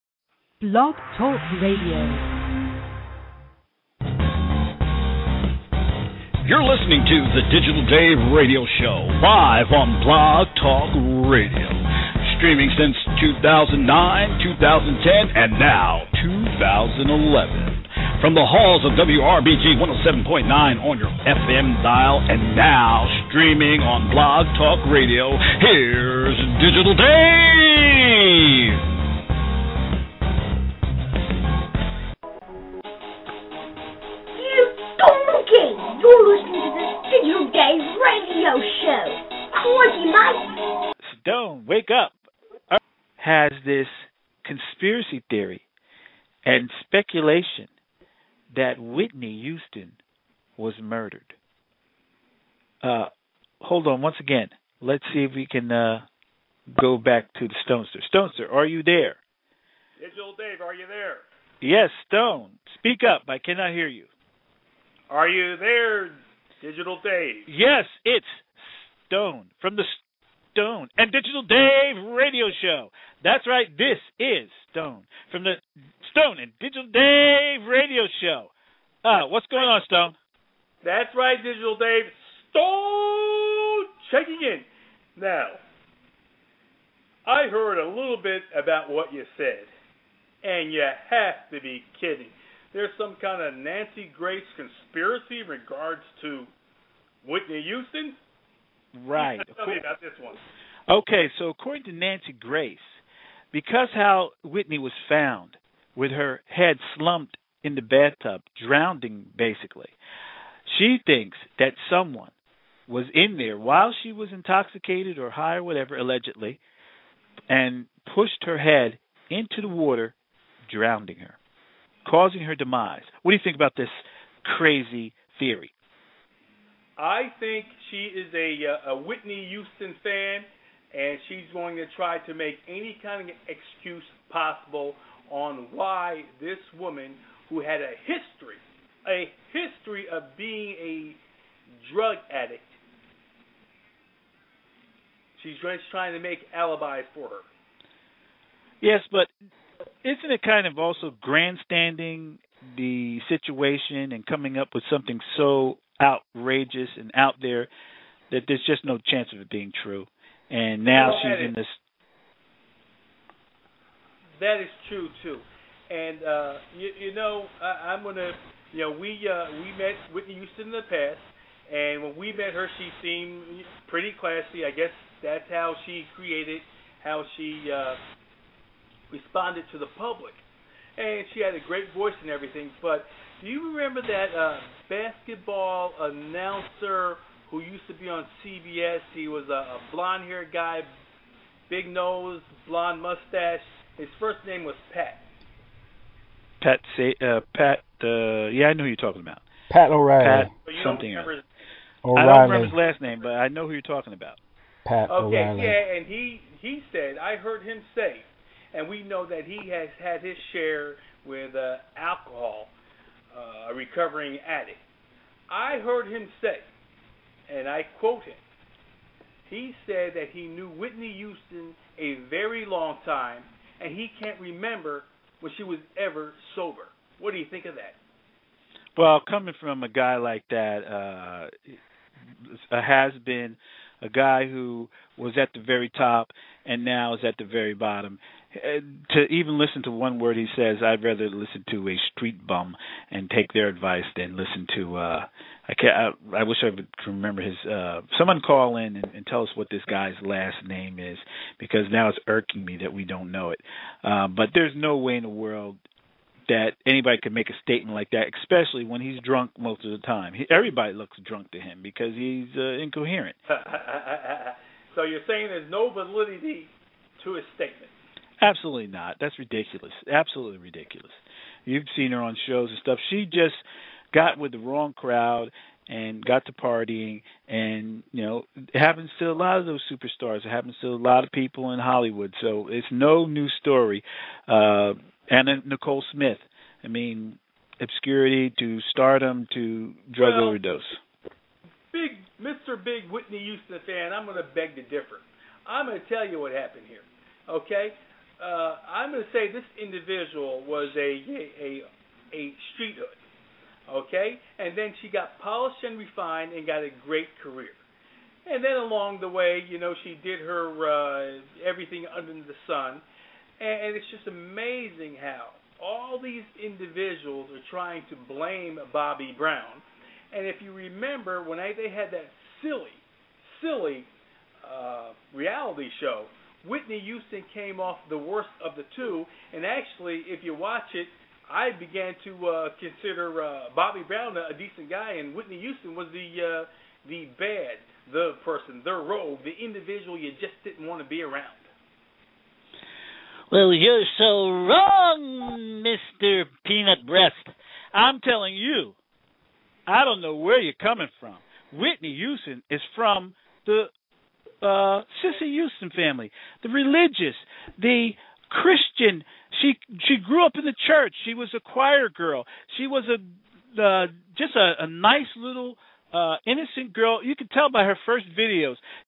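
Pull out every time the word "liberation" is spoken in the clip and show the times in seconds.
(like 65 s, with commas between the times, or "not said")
not said.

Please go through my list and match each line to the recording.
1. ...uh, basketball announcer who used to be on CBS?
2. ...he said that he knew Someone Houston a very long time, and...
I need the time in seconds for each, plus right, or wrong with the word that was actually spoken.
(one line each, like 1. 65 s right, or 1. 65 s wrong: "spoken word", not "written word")
1. 184 s right
2. 219 s wrong: "Whitney", not "Someone".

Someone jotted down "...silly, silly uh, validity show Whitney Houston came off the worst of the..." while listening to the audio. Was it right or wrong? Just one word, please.
wrong.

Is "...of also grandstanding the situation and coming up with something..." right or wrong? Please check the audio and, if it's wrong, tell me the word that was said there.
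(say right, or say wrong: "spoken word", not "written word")
right.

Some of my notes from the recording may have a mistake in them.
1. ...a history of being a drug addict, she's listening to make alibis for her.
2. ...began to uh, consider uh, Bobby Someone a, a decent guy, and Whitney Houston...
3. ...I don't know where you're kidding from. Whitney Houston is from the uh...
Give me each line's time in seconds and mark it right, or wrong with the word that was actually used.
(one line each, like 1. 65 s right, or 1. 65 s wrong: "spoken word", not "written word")
1. 139 s wrong: "trying", not "listening"
2. 331 s wrong: "Brown", not "Someone"
3. 349 s wrong: "coming", not "kidding".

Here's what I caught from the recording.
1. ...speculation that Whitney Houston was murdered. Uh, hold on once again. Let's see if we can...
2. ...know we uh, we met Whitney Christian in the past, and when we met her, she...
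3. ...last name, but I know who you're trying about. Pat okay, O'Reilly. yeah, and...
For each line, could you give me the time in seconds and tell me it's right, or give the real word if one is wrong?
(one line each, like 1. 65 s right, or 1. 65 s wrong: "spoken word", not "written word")
1. 46 s right
2. 168 s wrong: "Houston", not "Christian"
3. 202 s wrong: "talking", not "trying".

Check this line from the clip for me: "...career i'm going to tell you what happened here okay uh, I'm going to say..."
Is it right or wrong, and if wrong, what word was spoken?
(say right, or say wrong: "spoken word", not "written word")
wrong: "differ", not "career".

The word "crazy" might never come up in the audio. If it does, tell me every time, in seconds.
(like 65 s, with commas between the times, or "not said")
124 s.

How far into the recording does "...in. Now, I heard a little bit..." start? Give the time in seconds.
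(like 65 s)
84 s.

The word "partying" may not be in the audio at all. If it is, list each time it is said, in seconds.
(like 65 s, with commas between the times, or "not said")
276 s.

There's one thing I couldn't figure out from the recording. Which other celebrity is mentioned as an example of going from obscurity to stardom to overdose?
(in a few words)
Anna Nicole Smith.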